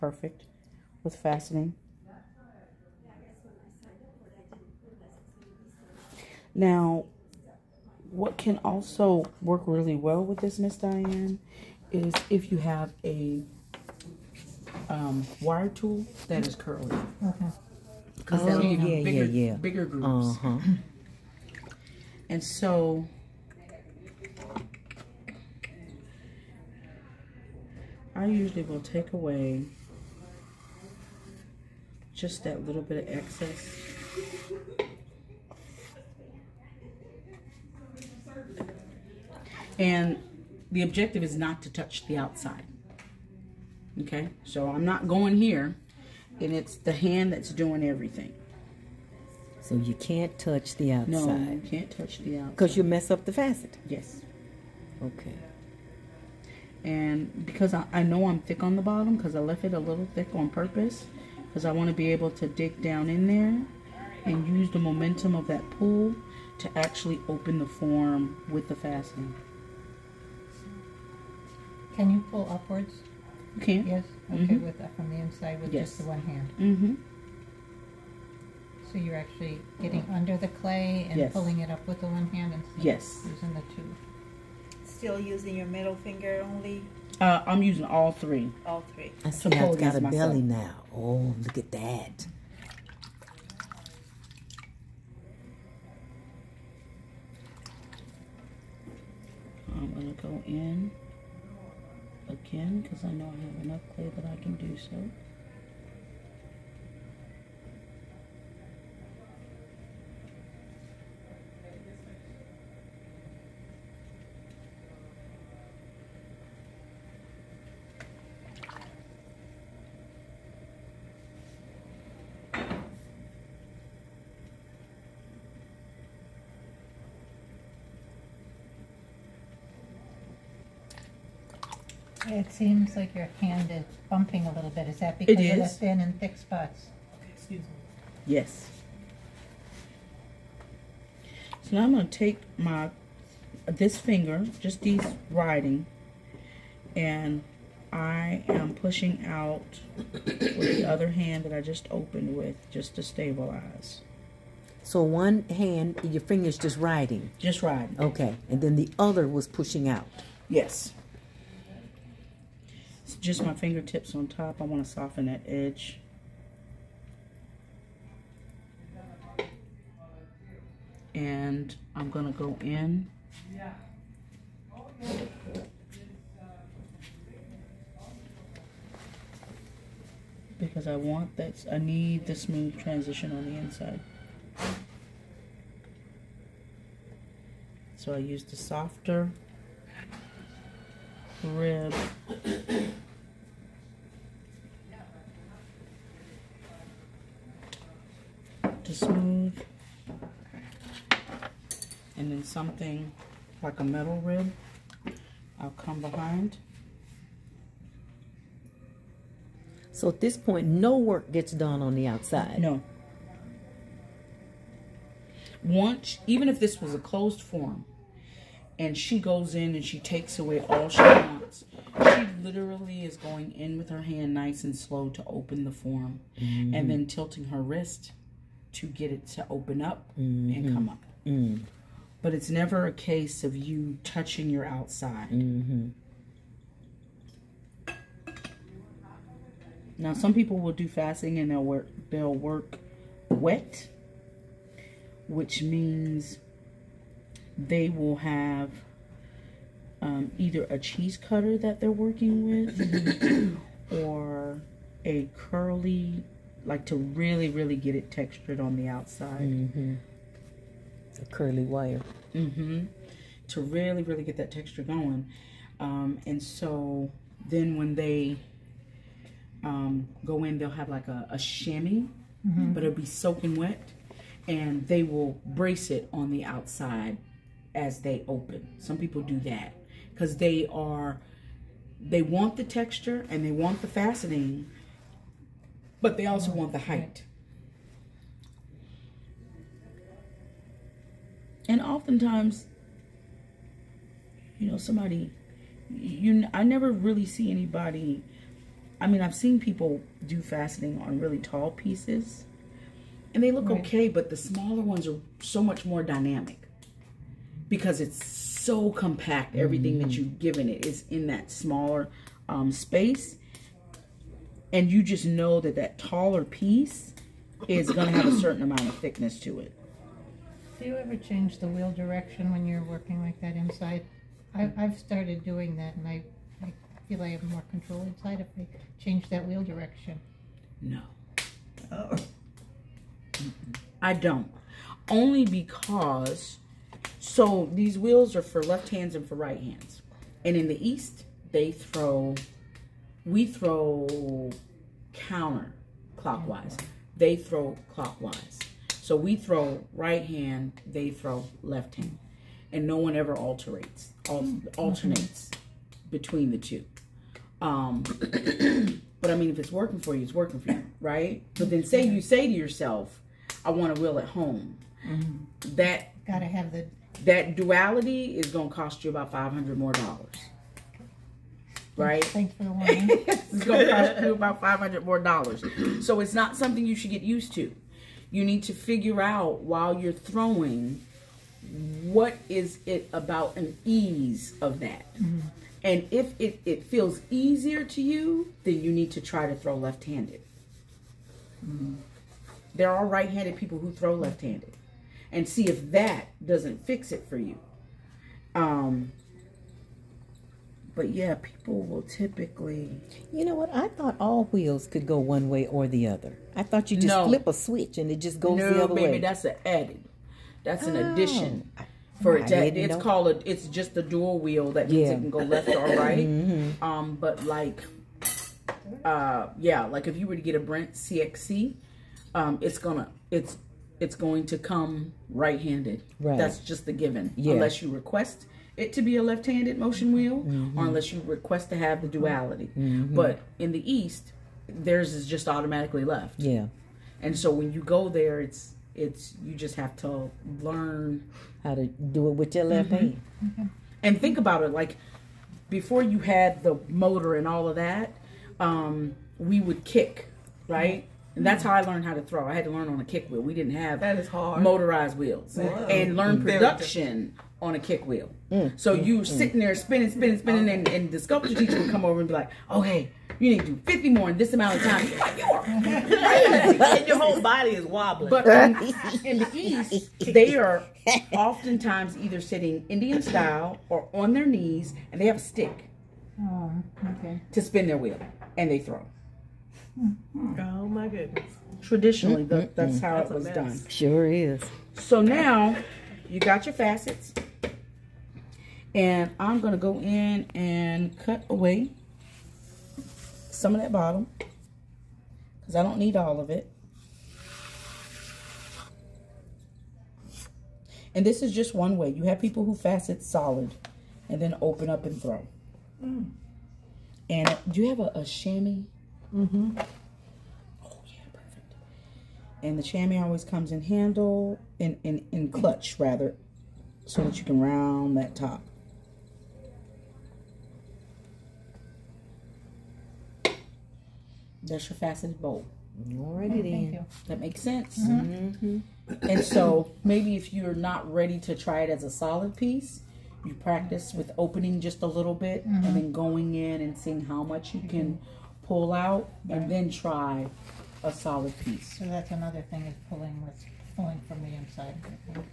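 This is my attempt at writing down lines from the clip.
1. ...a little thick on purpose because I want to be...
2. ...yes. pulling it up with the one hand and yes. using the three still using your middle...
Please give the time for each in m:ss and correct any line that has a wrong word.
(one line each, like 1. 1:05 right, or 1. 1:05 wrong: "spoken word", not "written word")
1. 0:59 right
2. 1:21 wrong: "two", not "three".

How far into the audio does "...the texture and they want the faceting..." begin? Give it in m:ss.
4:42.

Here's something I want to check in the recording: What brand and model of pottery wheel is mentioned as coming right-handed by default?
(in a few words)
Brent CXC.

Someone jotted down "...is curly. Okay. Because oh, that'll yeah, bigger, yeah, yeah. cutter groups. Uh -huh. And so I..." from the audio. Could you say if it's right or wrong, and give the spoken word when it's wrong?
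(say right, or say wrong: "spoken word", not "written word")
wrong: "bigger", not "cutter".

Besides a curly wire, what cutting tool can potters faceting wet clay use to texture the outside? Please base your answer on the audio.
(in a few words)
Cheese cutter.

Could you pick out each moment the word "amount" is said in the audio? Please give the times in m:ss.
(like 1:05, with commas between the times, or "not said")
5:18, 7:44.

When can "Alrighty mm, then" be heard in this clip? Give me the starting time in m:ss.
8:46.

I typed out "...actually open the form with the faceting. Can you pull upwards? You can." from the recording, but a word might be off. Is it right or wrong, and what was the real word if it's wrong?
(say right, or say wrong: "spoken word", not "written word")
right.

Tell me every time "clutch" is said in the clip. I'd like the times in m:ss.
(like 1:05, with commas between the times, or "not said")
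8:35.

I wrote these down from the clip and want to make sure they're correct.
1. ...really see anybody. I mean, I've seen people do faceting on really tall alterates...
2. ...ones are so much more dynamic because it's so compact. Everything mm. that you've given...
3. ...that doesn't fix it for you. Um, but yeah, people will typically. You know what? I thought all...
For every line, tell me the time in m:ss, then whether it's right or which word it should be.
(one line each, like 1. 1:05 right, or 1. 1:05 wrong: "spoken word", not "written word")
1. 4:56 wrong: "pieces", not "alterates"
2. 5:04 right
3. 6:35 right.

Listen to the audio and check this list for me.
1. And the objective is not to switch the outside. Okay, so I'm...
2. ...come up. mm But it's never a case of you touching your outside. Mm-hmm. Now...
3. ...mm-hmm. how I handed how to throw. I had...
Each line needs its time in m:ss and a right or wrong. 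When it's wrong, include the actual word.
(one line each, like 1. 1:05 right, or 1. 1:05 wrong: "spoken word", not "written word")
1. 0:39 wrong: "touch", not "switch"
2. 3:50 right
3. 7:31 wrong: "learned", not "handed".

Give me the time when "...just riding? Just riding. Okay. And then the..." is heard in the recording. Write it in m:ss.
2:36.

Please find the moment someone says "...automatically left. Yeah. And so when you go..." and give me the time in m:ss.
7:15.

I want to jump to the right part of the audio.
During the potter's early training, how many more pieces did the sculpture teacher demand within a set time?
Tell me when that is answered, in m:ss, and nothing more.
7:43.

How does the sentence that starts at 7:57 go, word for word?
to spin their wheel, and they throw.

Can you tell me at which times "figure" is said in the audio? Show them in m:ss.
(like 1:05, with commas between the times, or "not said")
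6:18.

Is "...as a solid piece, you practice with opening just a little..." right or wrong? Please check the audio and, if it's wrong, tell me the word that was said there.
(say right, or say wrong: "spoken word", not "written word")
right.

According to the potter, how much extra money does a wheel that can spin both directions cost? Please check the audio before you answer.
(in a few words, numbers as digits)
$500.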